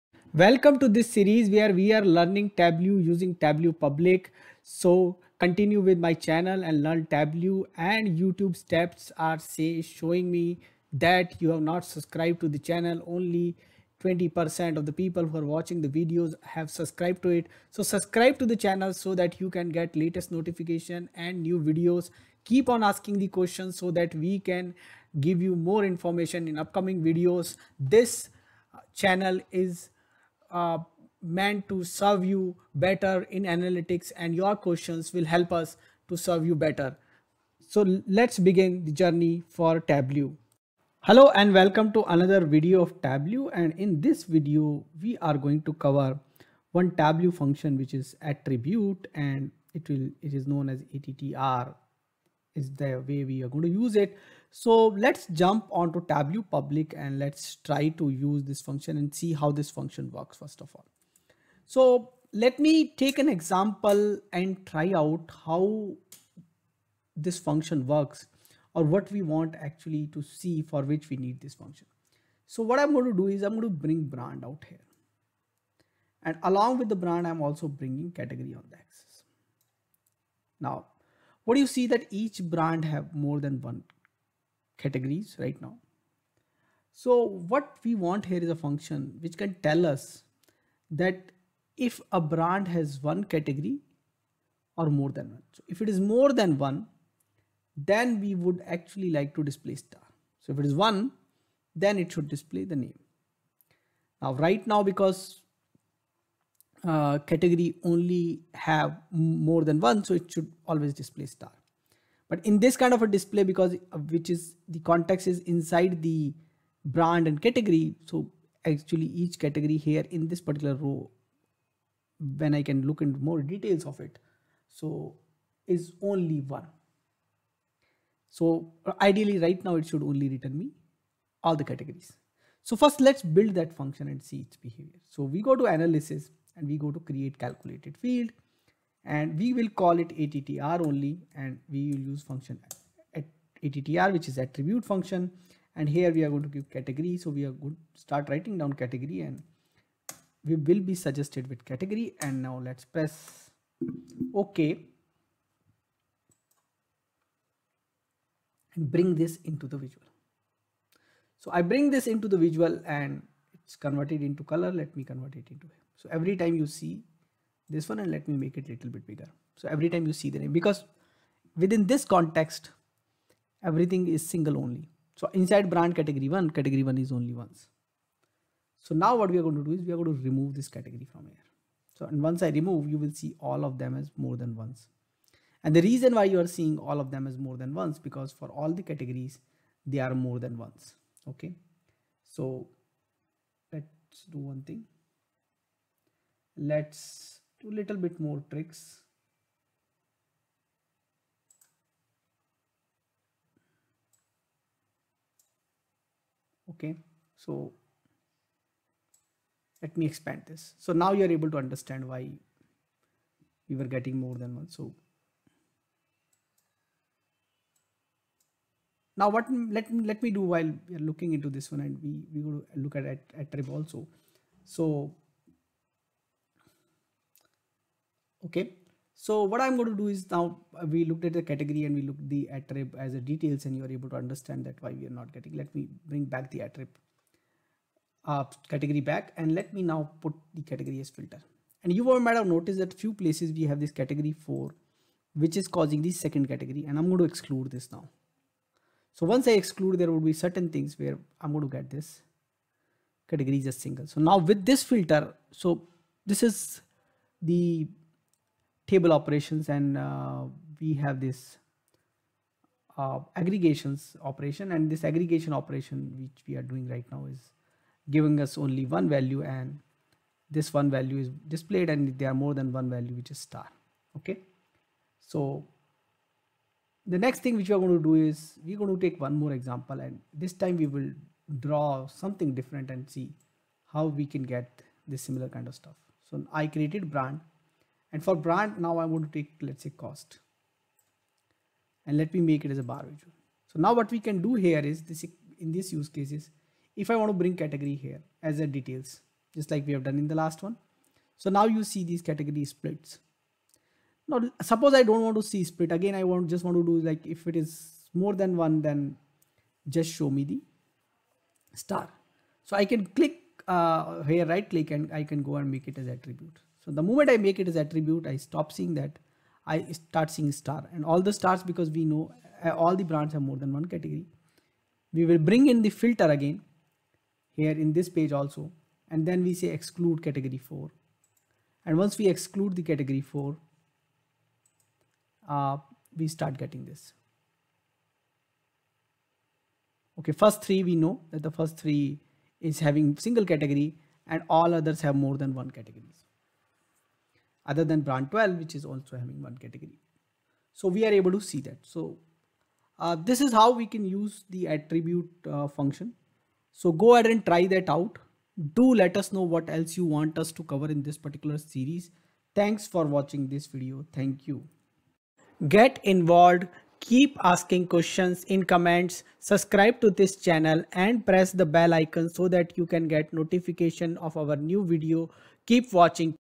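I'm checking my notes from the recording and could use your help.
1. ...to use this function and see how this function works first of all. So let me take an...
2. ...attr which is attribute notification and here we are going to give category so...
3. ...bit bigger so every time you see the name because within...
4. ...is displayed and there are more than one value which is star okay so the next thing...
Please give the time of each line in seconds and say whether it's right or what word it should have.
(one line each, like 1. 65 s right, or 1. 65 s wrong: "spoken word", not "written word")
1. 57 s right
2. 143 s wrong: "function", not "notification"
3. 168 s right
4. 271 s right.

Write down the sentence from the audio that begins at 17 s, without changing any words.
So subscribe to the channel so that you can get latest notification and new videos.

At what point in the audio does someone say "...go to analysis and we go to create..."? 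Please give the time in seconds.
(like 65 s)
135 s.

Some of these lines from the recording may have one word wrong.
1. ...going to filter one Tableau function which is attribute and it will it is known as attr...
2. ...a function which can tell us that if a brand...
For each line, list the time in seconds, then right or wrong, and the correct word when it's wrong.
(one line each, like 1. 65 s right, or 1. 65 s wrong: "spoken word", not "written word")
1. 45 s wrong: "cover", not "filter"
2. 88 s right.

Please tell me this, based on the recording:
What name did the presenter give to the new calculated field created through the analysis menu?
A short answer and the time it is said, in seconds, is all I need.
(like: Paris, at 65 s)
attr only, at 140 s.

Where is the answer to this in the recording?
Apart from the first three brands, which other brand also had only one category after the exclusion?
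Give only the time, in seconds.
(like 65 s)
348 s.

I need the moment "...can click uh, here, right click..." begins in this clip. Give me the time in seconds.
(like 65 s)
312 s.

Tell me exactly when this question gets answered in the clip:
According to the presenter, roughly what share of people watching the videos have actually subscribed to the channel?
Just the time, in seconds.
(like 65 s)
14 s.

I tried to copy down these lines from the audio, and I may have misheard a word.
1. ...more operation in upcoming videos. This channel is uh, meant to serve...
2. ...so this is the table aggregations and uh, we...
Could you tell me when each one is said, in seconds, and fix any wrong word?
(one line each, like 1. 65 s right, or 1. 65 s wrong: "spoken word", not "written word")
1. 25 s wrong: "information", not "operation"
2. 255 s wrong: "operations", not "aggregations".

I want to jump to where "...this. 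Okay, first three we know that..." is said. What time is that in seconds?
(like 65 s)
336 s.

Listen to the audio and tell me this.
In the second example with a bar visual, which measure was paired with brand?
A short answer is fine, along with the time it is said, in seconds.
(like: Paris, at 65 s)
Cost, at 289 s.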